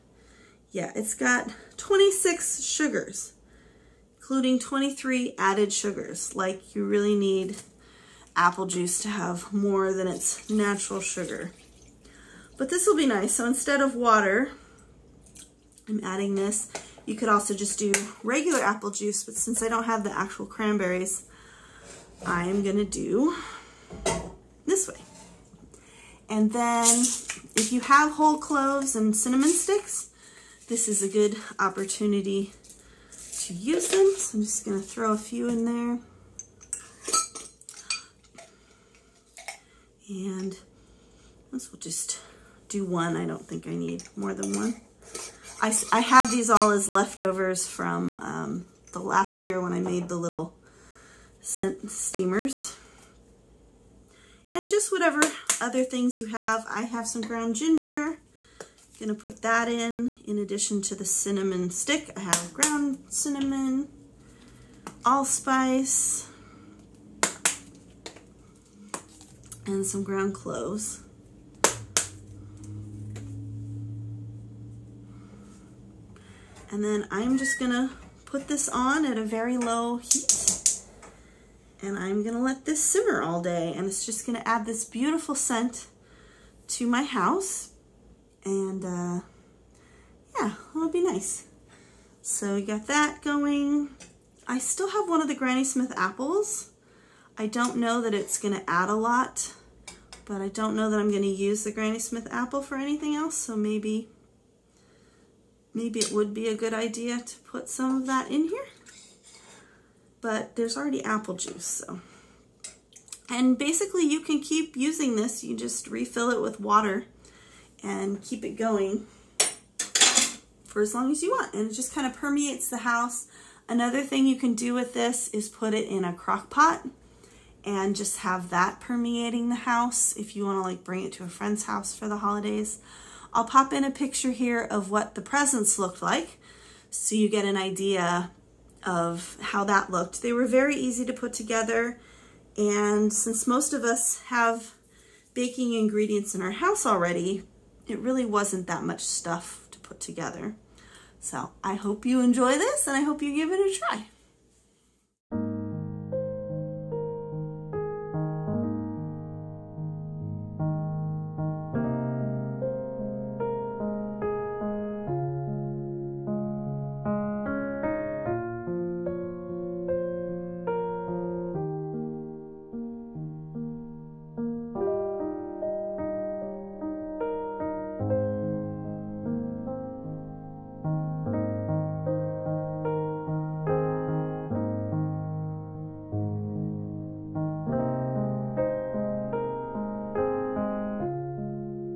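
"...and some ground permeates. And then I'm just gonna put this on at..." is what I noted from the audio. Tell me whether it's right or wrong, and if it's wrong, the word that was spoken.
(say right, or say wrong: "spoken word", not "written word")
wrong: "cloves", not "permeates".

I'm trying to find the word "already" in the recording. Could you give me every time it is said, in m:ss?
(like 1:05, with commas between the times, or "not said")
1:50, 2:26.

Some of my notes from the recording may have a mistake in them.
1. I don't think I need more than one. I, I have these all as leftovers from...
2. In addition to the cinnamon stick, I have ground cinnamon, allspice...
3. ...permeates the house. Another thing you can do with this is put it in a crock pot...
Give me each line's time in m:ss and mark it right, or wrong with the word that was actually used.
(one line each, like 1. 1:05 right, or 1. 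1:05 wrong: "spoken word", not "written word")
1. 0:43 right
2. 1:00 right
3. 2:02 right.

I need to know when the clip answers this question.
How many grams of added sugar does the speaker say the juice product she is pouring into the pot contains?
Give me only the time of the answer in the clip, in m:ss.
0:04.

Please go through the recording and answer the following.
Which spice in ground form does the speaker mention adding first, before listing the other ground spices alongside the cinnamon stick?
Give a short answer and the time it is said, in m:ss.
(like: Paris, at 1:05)
ginger, at 0:57.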